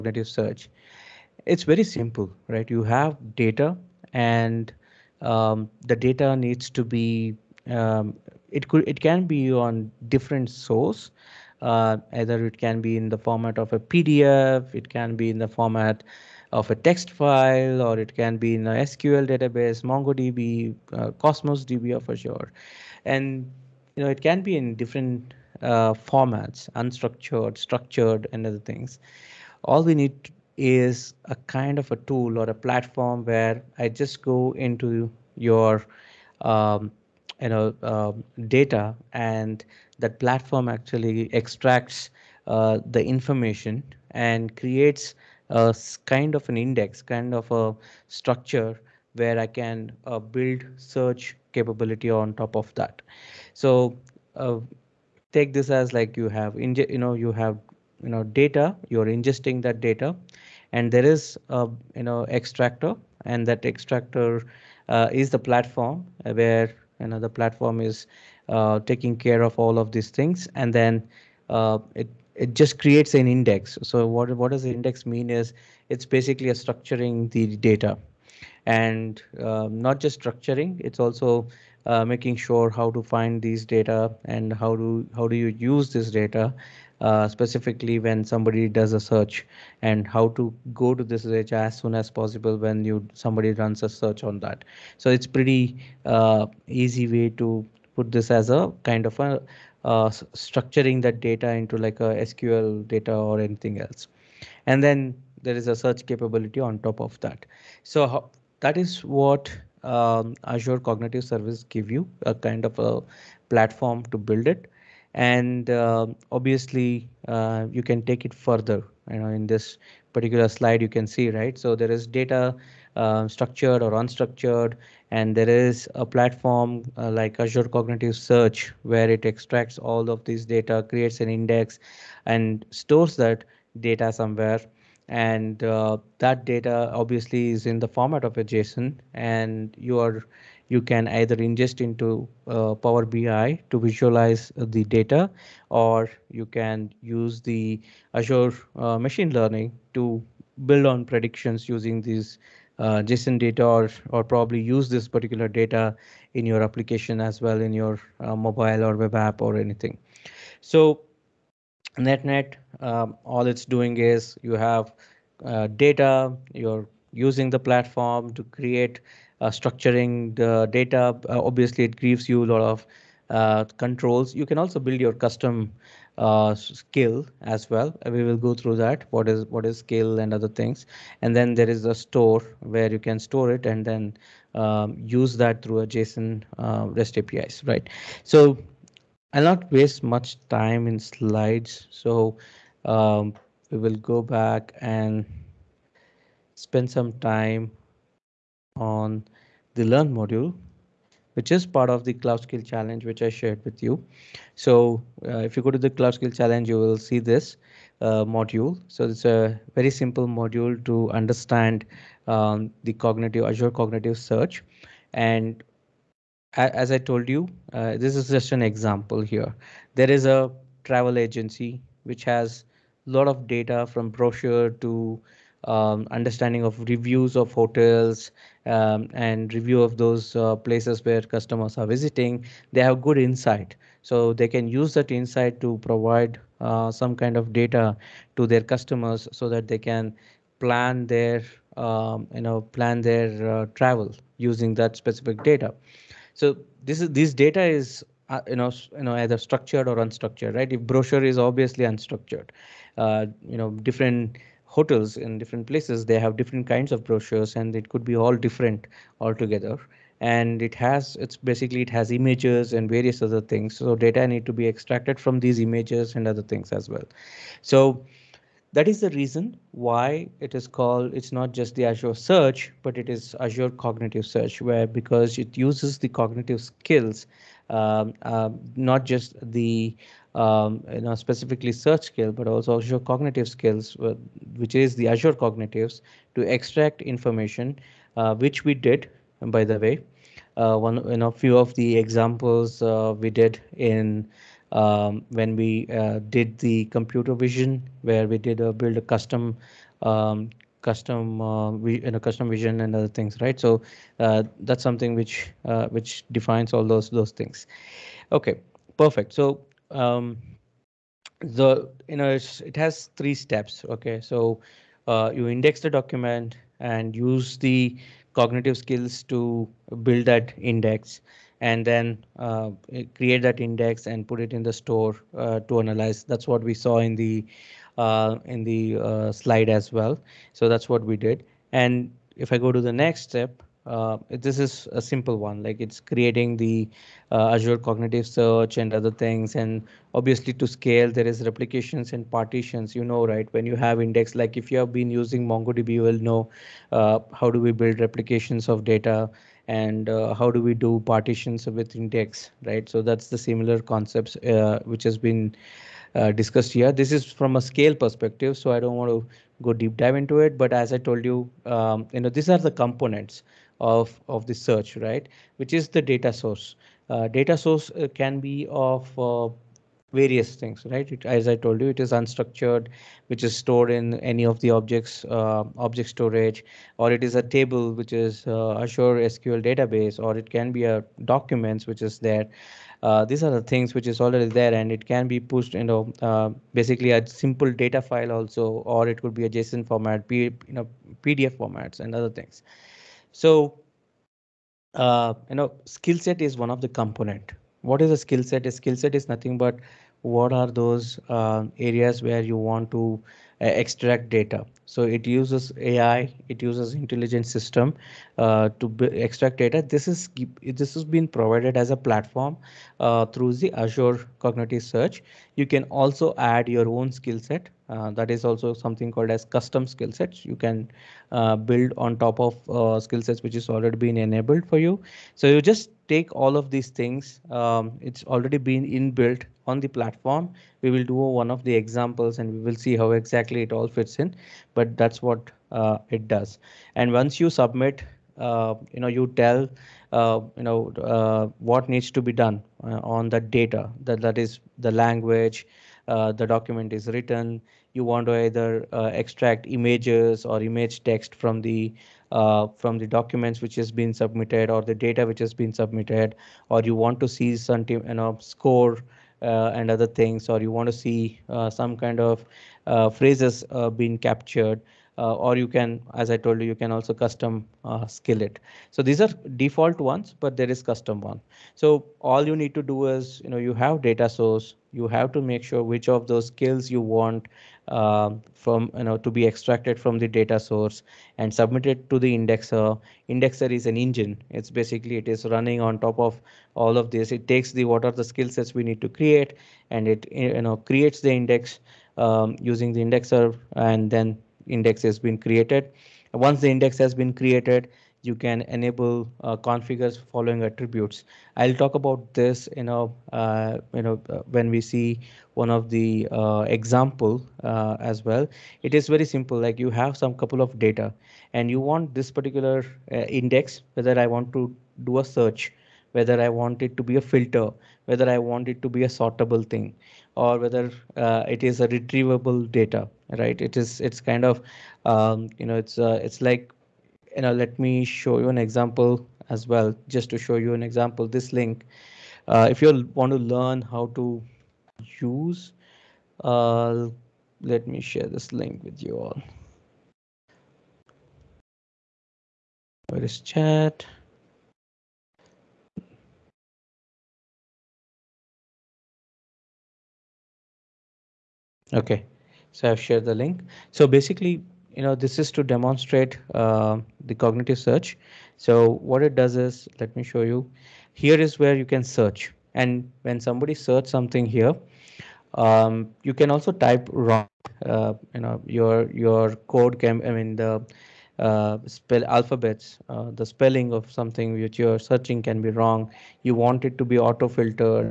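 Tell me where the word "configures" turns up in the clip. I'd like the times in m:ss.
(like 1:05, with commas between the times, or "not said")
8:19.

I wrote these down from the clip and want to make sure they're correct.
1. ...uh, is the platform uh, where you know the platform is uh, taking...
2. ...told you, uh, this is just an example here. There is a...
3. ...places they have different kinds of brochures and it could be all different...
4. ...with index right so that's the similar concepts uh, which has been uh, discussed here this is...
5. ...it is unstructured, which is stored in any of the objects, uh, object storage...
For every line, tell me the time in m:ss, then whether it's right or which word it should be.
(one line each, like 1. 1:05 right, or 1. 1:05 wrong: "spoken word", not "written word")
1. 1:04 right
2. 3:36 right
3. 4:15 right
4. 5:51 right
5. 6:11 right.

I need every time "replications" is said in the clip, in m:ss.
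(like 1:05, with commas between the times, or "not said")
5:41, 5:47.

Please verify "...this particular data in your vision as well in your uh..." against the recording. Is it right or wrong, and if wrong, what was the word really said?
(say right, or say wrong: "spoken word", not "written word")
wrong: "application", not "vision".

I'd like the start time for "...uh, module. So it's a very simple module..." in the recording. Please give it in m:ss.
3:27.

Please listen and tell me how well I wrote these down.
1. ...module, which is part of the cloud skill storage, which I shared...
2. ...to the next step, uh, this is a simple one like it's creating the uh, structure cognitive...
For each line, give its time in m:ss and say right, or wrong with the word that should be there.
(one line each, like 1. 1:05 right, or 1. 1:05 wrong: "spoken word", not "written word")
1. 3:20 wrong: "challenge", not "storage"
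2. 5:32 wrong: "azure", not "structure".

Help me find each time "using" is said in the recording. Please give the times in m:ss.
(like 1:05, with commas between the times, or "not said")
2:31, 2:47, 4:04, 5:45, 8:12.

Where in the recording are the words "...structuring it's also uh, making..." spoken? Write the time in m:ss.
1:20.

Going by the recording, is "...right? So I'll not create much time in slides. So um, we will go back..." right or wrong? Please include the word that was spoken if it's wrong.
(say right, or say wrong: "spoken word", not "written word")
wrong: "waste", not "create".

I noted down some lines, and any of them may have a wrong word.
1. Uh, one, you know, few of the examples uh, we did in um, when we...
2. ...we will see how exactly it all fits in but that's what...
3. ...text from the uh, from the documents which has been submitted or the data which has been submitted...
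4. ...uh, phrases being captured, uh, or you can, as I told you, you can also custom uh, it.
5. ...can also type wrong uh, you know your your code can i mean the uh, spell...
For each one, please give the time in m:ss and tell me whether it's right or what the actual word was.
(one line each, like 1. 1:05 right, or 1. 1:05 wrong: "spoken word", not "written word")
1. 4:50 right
2. 7:12 right
3. 7:31 right
4. 7:42 right
5. 9:26 right.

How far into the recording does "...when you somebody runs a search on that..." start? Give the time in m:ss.
1:32.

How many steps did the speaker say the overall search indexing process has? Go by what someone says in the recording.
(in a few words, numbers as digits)
3.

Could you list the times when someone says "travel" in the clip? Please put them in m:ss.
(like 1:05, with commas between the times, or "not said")
3:40, 4:03.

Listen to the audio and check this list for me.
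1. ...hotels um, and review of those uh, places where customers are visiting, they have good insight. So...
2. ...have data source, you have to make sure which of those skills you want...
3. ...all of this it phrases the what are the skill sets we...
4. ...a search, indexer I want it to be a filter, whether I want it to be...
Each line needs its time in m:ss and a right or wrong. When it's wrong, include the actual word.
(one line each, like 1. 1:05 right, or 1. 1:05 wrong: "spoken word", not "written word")
1. 3:47 right
2. 7:53 right
3. 8:06 wrong: "takes", not "phrases"
4. 8:35 wrong: "whether", not "indexer".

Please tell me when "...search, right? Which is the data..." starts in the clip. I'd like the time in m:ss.
6:04.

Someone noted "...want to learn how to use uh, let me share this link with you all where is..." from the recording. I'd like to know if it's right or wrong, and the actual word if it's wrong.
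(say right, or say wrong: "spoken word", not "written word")
right.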